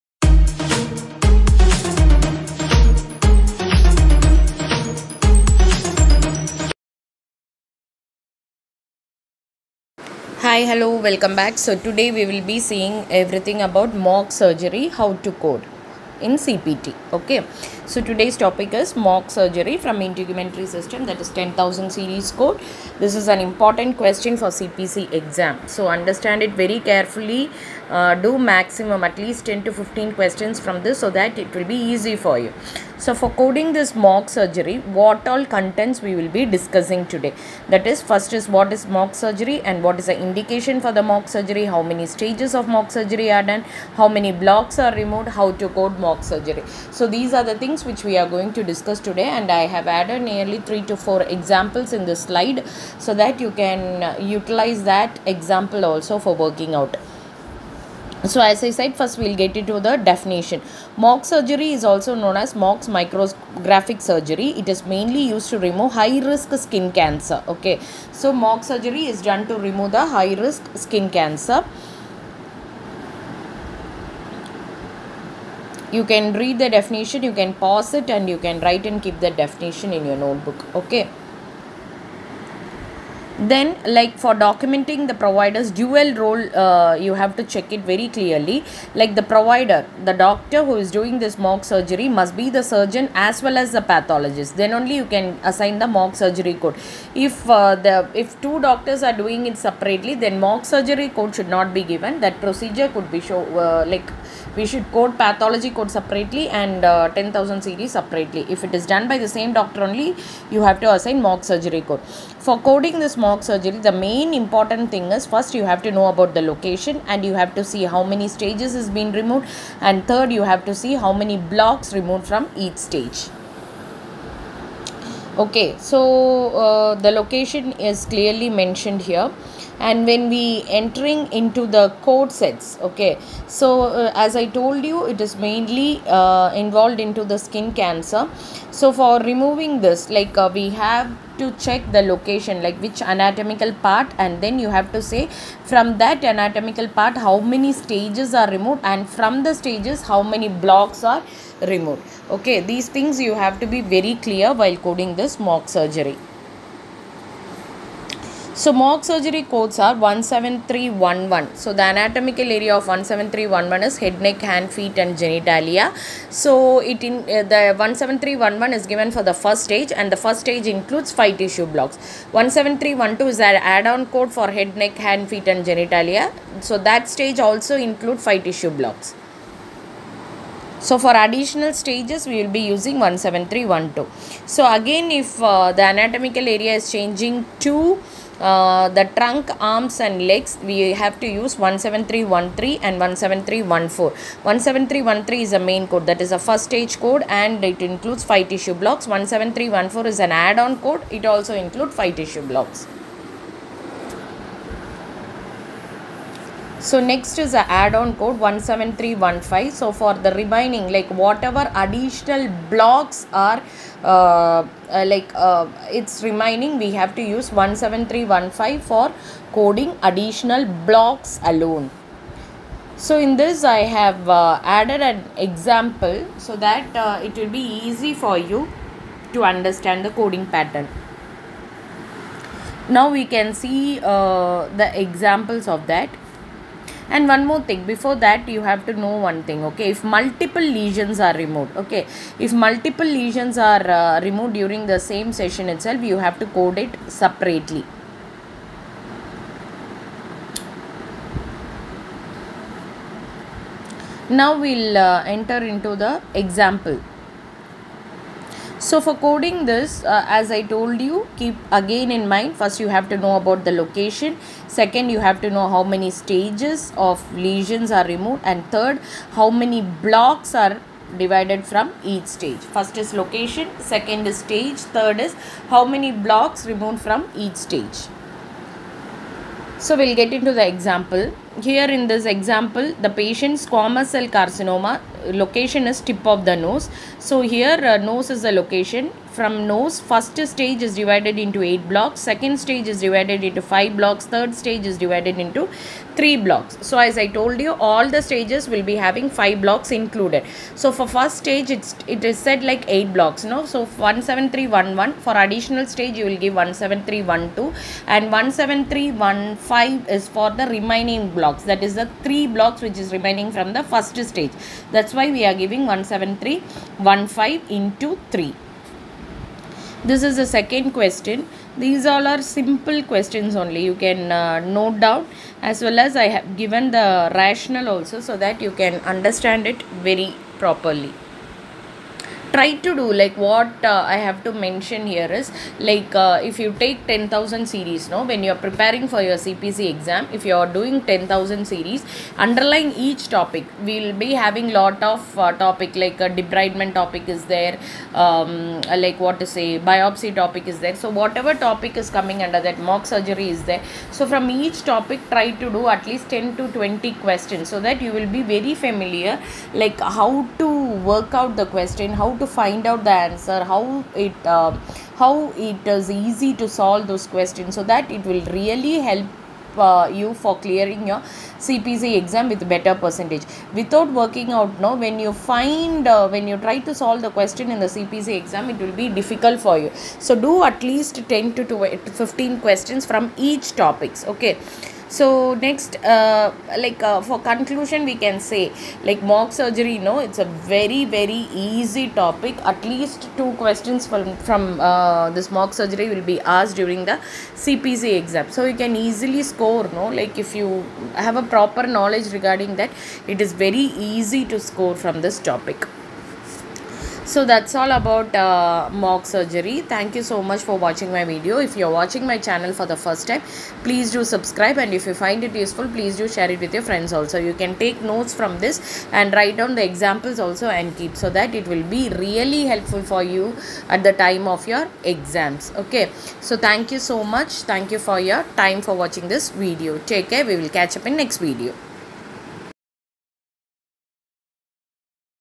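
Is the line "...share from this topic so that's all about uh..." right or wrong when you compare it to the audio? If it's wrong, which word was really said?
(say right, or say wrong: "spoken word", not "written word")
wrong: "score", not "share".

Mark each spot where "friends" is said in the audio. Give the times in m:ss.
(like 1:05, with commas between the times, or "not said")
6:56.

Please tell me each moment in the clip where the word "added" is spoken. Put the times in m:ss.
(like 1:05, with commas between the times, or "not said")
0:49, 3:44.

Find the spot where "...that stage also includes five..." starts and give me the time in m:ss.
2:56.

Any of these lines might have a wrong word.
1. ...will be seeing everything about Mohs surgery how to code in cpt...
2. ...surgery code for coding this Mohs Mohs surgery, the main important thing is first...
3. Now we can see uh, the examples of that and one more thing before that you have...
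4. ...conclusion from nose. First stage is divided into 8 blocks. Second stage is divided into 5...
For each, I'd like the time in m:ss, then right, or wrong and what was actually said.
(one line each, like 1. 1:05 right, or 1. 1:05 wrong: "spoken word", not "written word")
1. 0:12 right
2. 1:51 right
3. 3:52 right
4. 4:48 wrong: "location", not "conclusion".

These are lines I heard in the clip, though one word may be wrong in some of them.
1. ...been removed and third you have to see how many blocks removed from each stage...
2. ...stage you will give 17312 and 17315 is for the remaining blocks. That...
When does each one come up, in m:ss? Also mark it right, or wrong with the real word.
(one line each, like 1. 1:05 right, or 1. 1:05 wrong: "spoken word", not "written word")
1. 1:58 right
2. 5:05 right.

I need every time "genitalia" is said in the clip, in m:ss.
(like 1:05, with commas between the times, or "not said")
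2:45, 2:55.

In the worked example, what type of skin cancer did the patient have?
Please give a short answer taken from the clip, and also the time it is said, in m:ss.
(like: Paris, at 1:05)
squamous cell carcinoma, at 4:43.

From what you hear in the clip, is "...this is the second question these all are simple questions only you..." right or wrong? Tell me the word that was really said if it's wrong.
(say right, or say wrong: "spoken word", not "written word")
right.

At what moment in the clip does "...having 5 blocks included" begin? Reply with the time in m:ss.
4:58.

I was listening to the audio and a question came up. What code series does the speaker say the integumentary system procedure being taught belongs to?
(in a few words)
10000 series.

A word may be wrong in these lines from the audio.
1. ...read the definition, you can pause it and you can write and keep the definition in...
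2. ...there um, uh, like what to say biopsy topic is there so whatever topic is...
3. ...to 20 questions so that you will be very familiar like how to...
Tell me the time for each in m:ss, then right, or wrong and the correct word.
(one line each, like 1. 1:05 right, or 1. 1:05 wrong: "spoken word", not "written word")
1. 1:16 right
2. 5:47 right
3. 5:56 right.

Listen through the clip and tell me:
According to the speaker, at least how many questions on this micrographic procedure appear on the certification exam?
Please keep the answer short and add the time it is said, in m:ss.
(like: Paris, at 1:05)
2, at 6:32.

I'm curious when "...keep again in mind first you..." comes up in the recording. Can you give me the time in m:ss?
4:21.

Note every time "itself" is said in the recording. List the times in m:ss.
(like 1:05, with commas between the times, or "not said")
4:05.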